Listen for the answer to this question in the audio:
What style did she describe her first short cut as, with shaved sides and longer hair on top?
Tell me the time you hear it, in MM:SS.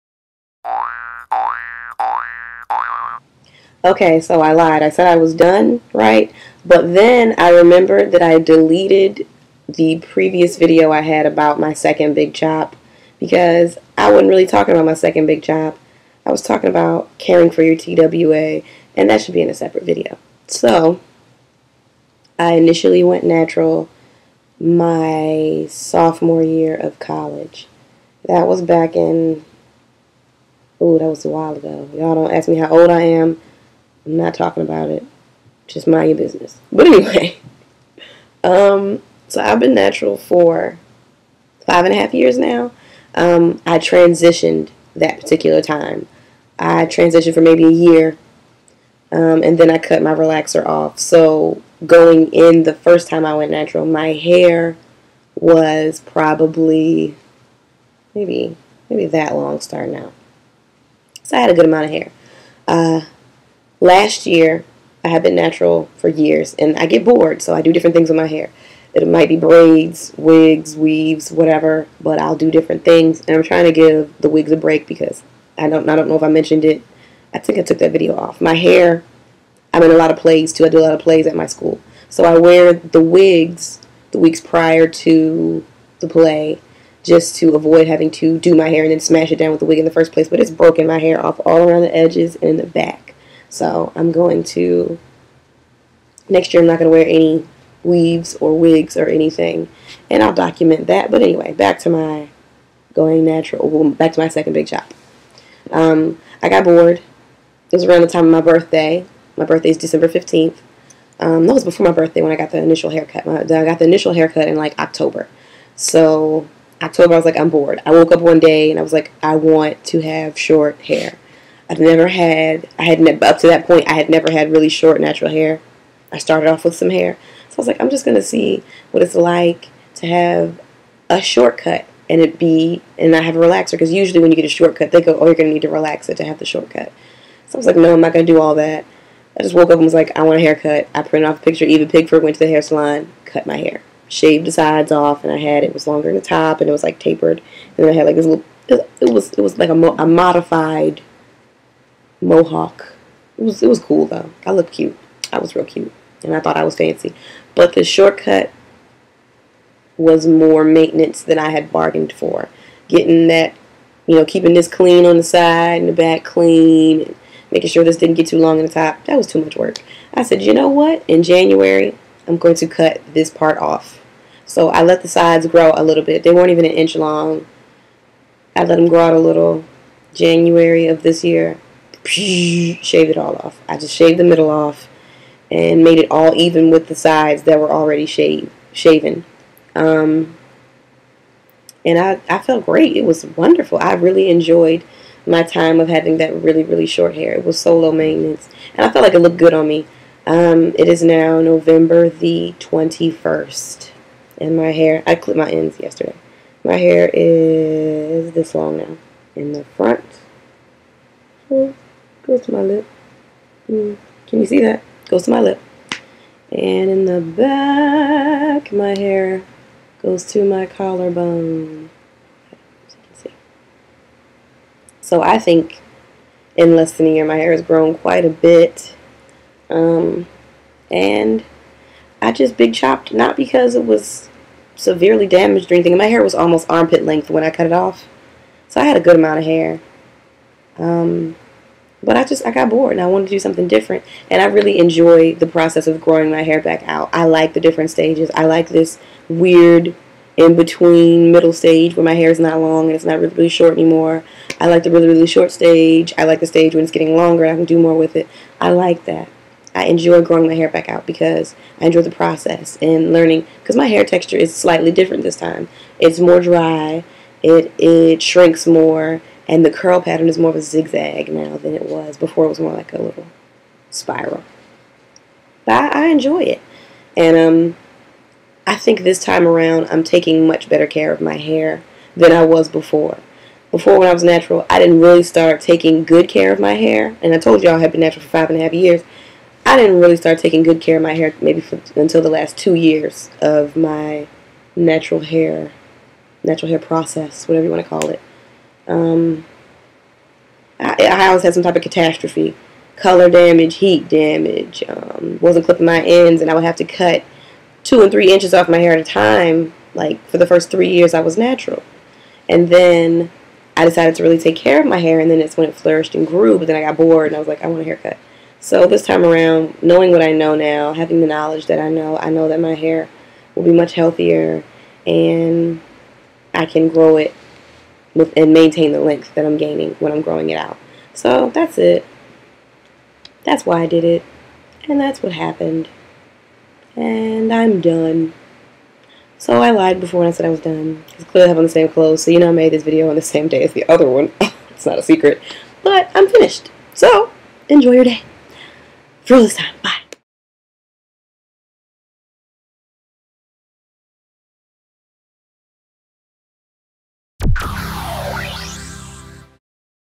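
02:30.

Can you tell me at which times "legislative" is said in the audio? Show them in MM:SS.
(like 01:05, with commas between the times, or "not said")
not said.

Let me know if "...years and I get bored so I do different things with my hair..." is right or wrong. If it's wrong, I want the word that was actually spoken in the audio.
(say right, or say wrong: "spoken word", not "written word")
right.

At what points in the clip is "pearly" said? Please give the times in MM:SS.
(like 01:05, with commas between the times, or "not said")
not said.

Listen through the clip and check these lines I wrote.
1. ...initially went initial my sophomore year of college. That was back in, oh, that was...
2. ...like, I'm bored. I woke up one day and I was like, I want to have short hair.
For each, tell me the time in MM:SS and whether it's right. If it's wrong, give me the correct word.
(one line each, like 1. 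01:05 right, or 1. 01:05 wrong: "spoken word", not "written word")
1. 00:22 wrong: "natural", not "initial"
2. 01:57 right.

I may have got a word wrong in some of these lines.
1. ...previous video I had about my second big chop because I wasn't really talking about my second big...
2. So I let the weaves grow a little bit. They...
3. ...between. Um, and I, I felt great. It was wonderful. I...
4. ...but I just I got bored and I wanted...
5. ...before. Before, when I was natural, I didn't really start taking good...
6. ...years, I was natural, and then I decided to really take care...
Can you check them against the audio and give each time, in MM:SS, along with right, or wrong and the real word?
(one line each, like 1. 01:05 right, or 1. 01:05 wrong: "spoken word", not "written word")
1. 00:09 right
2. 02:54 wrong: "sides", not "weaves"
3. 03:08 wrong: "shaven", not "between"
4. 04:02 right
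5. 04:42 right
6. 05:10 right.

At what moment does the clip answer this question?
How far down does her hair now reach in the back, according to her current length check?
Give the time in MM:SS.
03:40.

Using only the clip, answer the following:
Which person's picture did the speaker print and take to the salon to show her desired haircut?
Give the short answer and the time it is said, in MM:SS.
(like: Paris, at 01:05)
Eva Pigford, at 02:21.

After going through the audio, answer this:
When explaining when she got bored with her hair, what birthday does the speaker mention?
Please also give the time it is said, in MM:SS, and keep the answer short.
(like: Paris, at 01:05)
December 15th, at 01:49.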